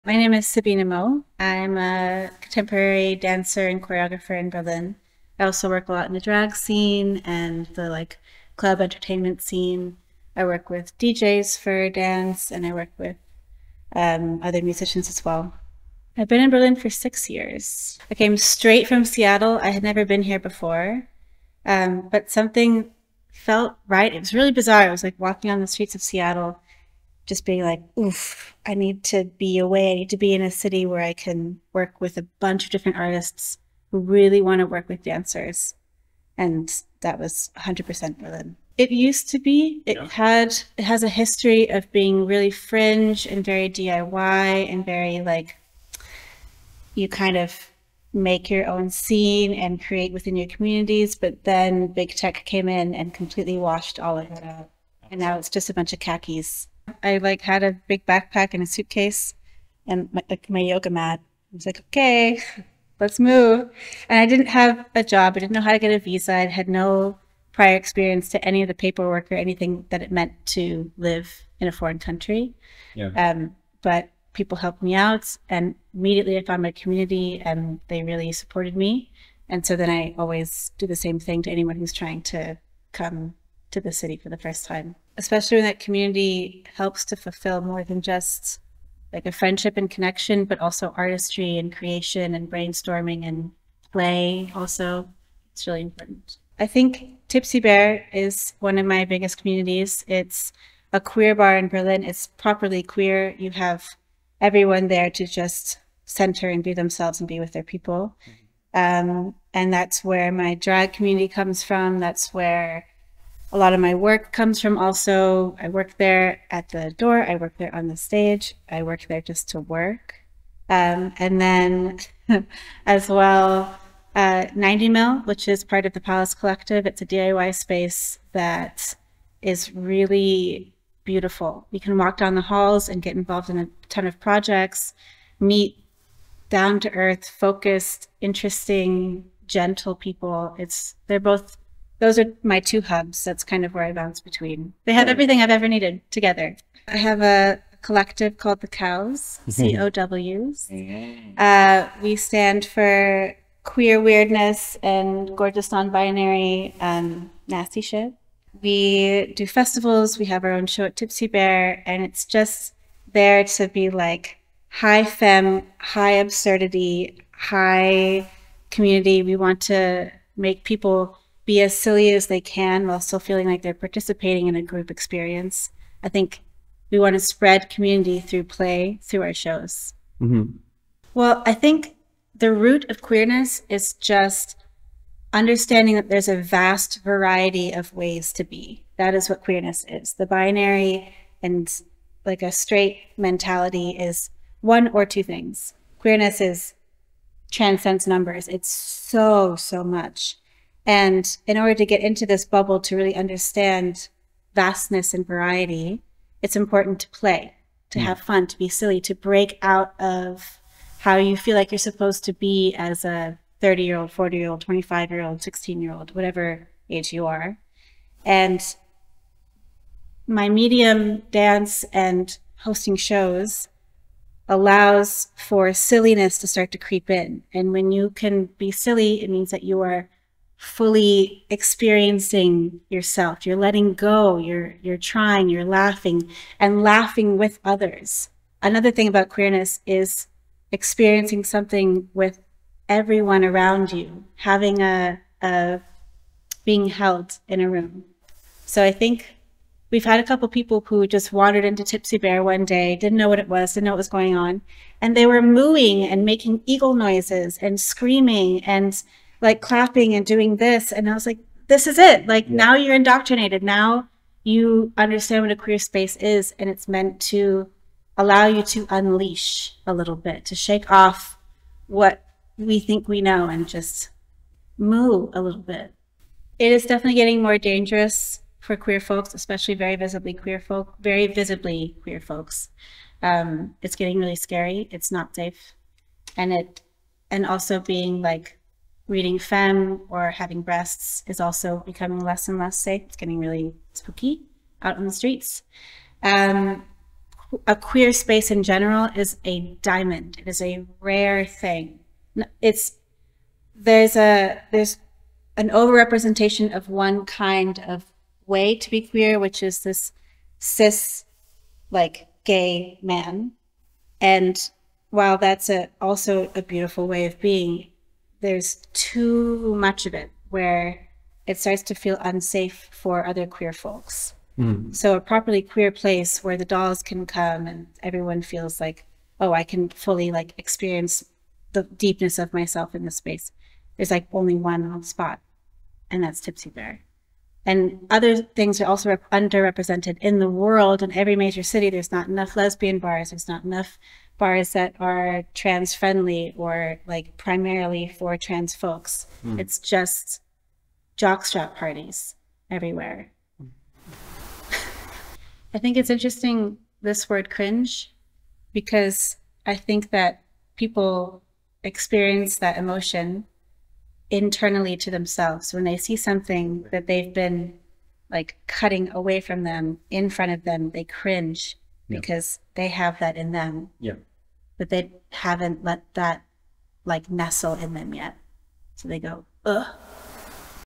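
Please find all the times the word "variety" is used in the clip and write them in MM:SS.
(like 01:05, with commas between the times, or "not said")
03:07, 03:25.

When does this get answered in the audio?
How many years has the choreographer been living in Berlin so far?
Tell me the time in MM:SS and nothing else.
00:16.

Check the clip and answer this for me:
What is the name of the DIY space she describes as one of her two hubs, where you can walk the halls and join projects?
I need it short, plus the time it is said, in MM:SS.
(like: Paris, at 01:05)
90 Mill, at 02:04.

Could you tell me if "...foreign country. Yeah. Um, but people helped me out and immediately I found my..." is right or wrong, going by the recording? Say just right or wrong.
right.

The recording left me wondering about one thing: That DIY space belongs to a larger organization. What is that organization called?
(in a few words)
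Palace Collective.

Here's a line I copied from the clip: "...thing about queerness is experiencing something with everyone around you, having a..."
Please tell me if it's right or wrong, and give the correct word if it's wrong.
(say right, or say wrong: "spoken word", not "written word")
right.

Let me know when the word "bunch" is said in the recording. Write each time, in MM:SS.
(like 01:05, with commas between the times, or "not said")
00:32, 00:55.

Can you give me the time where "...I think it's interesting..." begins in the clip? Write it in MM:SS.
05:55.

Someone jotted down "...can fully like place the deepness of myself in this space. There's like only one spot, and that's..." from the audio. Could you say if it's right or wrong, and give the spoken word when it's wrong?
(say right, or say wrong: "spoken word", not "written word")
wrong: "experience", not "place".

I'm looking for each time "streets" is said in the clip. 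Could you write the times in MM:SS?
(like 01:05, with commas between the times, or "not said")
00:25, 04:55.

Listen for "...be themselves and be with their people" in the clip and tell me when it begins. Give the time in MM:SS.
01:46.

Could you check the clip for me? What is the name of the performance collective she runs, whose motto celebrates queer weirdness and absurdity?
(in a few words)
the Cows.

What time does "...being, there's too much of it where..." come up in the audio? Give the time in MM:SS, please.
05:17.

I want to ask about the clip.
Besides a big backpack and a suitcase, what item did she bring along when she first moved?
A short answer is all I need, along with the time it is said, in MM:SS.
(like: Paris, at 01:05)
yoga mat, at 01:00.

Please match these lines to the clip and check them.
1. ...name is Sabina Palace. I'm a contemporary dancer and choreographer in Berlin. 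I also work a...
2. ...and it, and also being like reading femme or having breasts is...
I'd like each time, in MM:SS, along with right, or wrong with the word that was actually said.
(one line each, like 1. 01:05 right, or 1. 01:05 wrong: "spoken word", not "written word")
1. 00:00 wrong: "Moe", not "Palace"
2. 04:46 right.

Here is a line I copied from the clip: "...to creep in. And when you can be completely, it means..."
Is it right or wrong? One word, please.
wrong.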